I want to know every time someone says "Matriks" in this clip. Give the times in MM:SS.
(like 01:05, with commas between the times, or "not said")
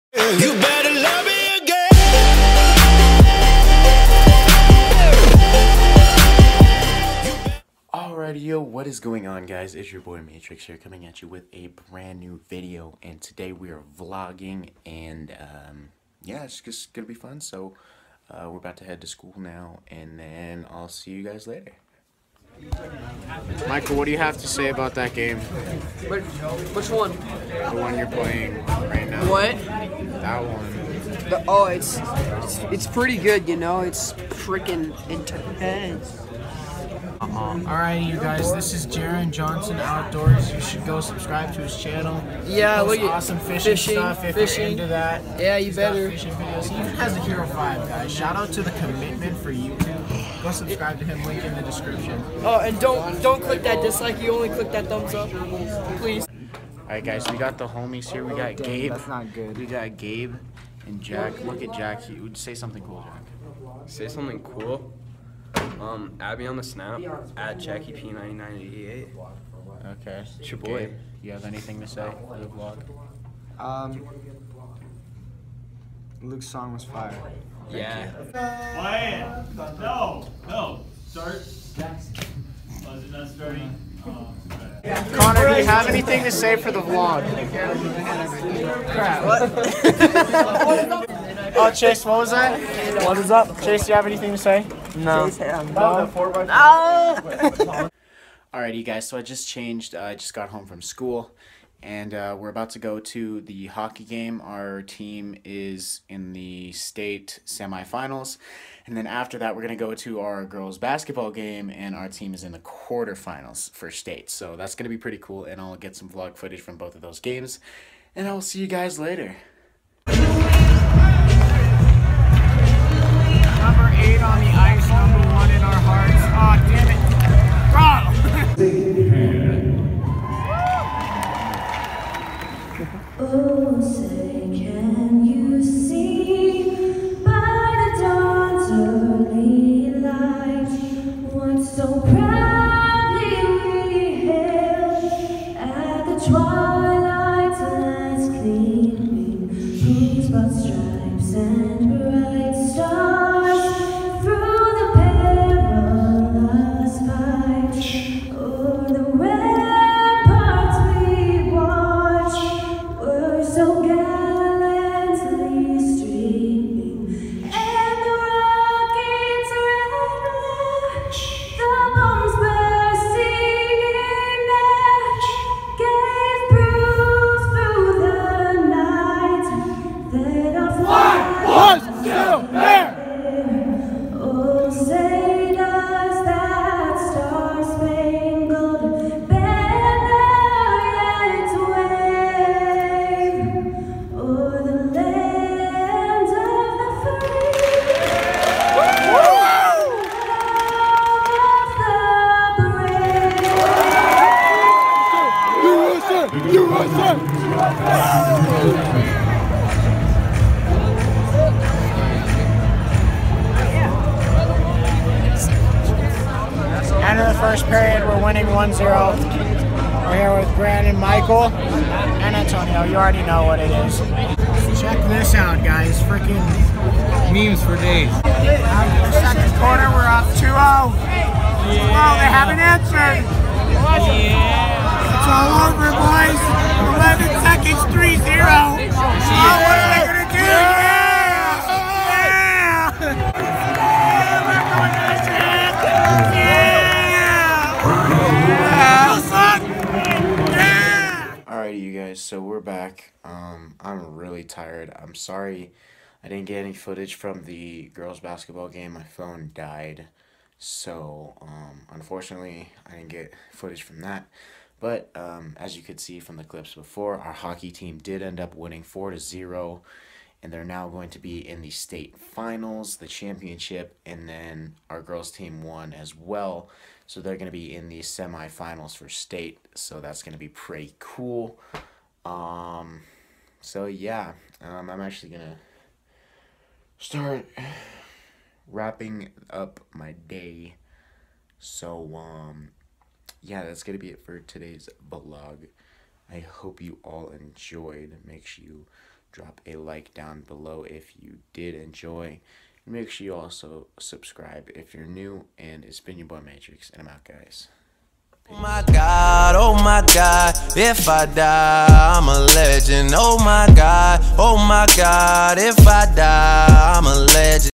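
00:10, 05:06.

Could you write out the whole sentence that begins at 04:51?
So um, yeah, that's gonna be it for today's vlog.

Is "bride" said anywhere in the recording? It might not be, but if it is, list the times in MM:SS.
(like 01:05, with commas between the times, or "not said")
not said.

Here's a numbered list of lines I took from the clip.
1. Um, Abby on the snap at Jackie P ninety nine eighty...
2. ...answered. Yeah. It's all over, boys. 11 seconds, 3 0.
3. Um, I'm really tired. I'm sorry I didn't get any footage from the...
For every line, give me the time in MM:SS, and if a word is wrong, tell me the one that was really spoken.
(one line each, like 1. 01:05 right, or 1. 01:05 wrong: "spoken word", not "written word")
1. 01:05 right
2. 03:52 right
3. 04:13 right.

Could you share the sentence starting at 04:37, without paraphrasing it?
So they're going to be in the semifinals for state.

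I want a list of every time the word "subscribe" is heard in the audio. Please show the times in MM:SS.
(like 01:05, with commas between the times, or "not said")
00:41, 00:50, 05:03.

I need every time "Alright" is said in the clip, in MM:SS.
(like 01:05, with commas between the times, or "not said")
00:37, 00:56, 01:38.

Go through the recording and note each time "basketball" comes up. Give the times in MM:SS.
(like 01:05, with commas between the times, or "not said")
01:50, 04:18.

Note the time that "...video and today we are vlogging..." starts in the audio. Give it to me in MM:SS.
00:12.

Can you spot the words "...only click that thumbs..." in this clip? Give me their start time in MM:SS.
00:54.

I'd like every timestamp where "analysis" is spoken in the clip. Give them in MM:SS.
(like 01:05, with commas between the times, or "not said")
not said.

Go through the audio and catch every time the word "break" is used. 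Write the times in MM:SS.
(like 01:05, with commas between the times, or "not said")
not said.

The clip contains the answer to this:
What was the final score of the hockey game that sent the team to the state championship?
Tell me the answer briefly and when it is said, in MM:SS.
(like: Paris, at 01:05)
4 to 0, at 04:28.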